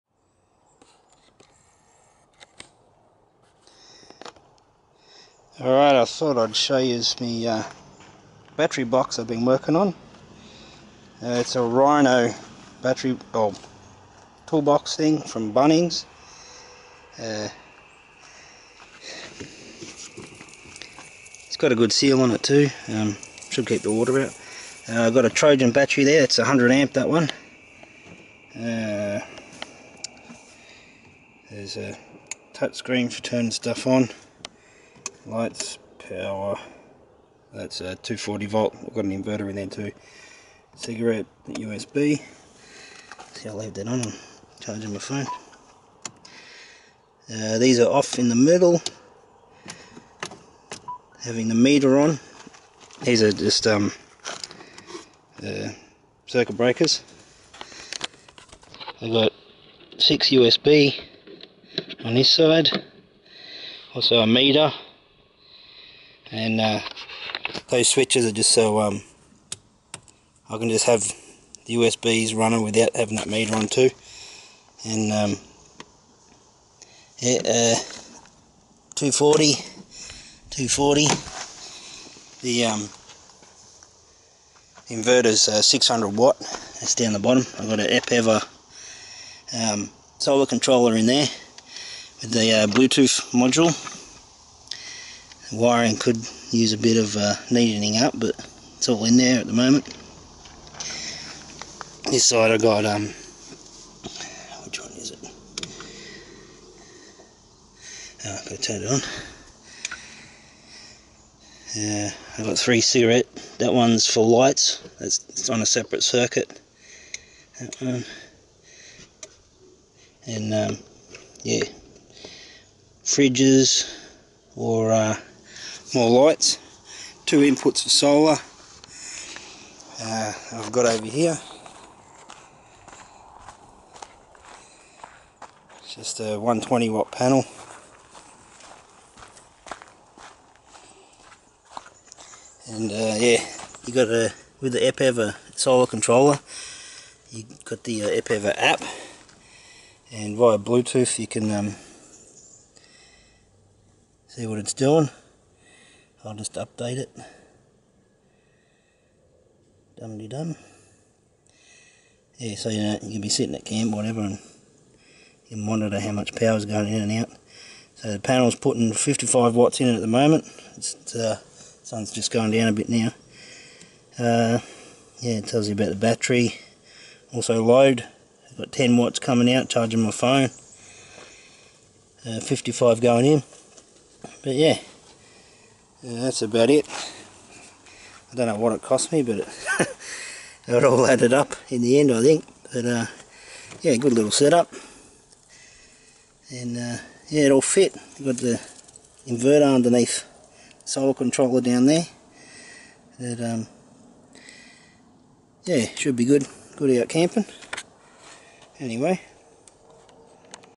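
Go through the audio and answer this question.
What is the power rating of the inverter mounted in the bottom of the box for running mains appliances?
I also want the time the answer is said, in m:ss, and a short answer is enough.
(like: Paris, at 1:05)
600 watt, at 1:25.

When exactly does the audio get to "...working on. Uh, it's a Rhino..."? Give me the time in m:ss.
0:09.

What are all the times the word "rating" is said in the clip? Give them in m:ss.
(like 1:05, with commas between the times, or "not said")
not said.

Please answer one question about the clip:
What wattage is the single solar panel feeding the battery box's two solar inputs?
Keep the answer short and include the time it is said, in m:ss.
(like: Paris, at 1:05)
120 watt, at 2:16.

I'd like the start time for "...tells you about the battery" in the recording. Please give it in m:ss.
2:55.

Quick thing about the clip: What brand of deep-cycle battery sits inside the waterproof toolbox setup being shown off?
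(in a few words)
Trojan.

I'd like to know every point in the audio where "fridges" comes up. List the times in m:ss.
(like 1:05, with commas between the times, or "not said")
2:03.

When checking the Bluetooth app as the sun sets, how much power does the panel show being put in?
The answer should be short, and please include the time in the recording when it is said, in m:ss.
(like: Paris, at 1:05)
55 watts, at 2:48.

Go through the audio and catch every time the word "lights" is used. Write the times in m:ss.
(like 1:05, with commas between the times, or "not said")
0:35, 1:54, 2:06.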